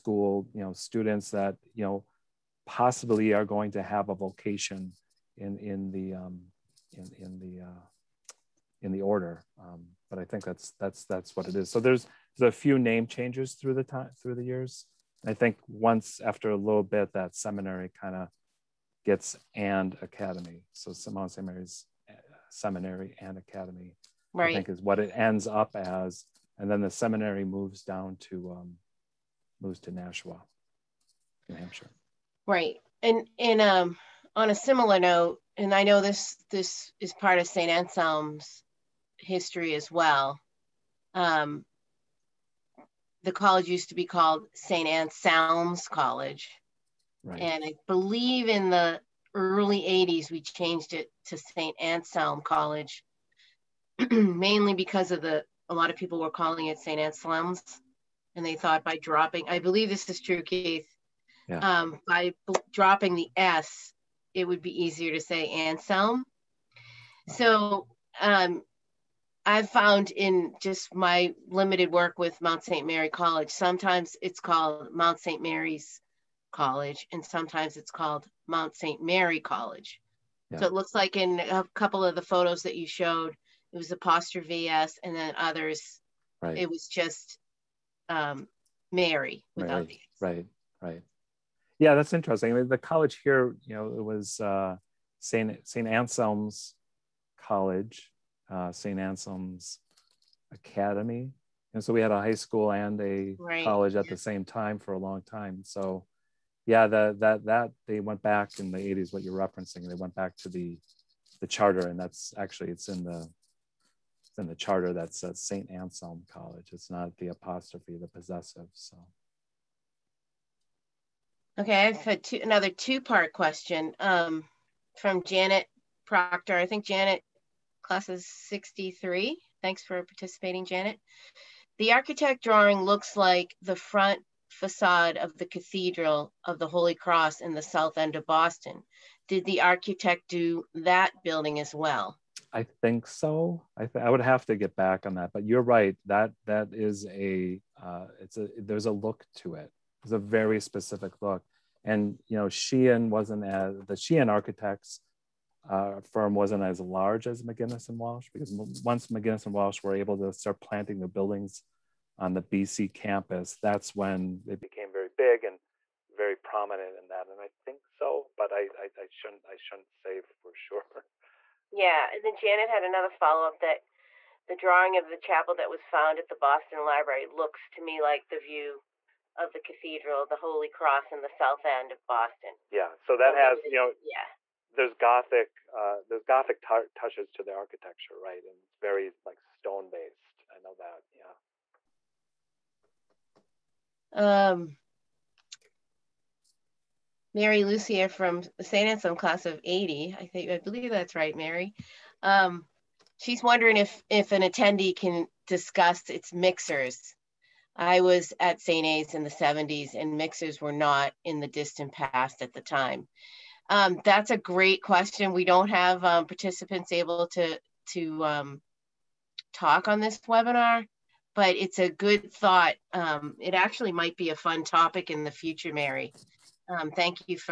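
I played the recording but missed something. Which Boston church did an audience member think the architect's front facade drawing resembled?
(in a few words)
Cathedral of the Holy Cross.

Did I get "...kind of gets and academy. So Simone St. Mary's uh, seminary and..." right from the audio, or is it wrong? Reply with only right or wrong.
right.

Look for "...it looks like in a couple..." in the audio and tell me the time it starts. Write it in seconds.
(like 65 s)
80 s.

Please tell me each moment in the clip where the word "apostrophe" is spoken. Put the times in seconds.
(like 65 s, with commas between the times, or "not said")
83 s, 117 s.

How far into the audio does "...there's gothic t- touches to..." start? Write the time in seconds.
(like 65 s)
186 s.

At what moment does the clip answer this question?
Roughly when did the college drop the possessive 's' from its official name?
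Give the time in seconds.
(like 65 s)
49 s.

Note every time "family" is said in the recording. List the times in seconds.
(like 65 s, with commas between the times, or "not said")
not said.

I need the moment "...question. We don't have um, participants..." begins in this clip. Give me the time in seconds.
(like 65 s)
214 s.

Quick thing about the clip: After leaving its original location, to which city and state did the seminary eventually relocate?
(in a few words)
Nashua, New Hampshire.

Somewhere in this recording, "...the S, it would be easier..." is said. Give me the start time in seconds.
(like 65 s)
63 s.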